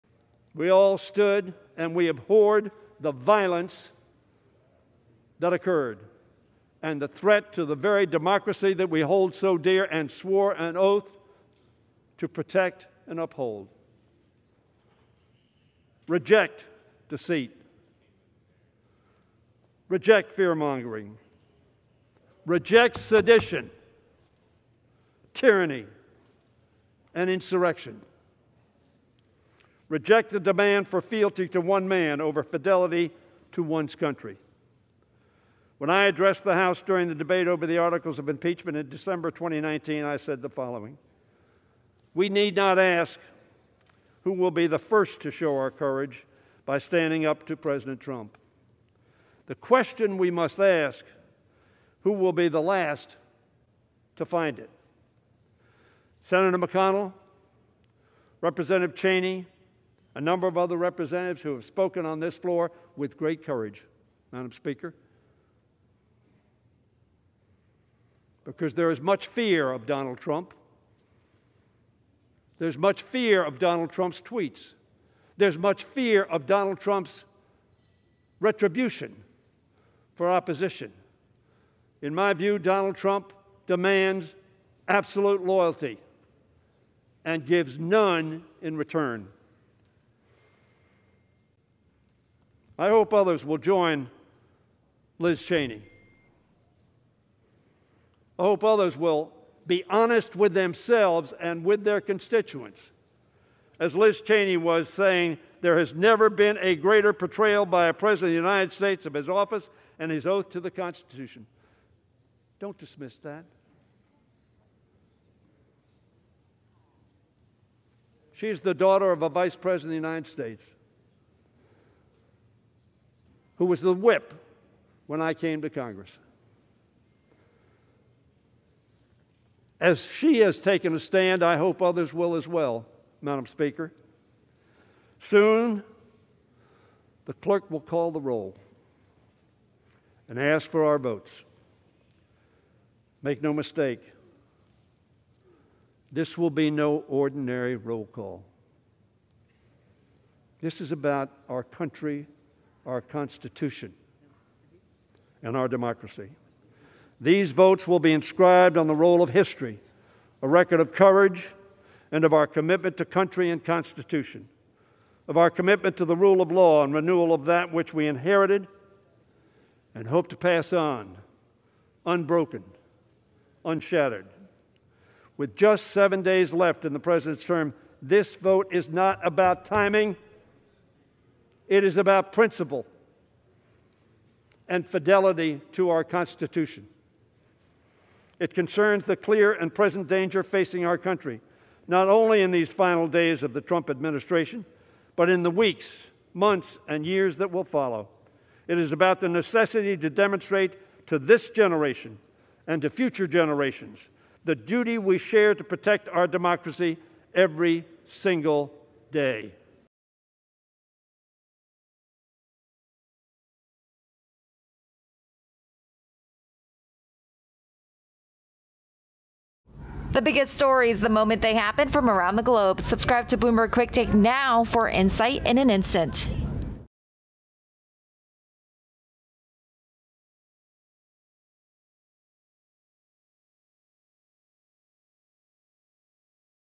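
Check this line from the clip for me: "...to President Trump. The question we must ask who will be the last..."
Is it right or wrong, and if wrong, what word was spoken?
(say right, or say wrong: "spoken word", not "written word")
right.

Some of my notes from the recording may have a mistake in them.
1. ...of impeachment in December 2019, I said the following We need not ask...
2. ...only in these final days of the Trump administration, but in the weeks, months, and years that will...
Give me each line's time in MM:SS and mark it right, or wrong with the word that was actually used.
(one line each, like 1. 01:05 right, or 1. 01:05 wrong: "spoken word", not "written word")
1. 00:38 right
2. 03:12 right.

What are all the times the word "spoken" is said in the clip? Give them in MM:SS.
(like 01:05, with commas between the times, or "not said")
01:01.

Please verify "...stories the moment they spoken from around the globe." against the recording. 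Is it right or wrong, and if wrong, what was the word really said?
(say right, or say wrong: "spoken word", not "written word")
wrong: "happen", not "spoken".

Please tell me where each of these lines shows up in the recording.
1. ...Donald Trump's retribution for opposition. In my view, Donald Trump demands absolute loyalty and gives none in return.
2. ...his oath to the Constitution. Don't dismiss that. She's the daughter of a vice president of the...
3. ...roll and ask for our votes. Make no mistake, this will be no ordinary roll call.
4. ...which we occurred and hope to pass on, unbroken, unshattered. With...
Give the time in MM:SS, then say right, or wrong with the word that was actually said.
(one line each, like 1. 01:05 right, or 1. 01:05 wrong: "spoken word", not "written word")
1. 01:16 right
2. 01:50 right
3. 02:18 right
4. 02:47 wrong: "inherited", not "occurred".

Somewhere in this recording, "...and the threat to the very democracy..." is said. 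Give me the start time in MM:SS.
00:06.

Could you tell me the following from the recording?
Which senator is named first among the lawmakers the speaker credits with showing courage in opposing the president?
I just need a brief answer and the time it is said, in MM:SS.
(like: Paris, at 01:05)
McConnell, at 00:56.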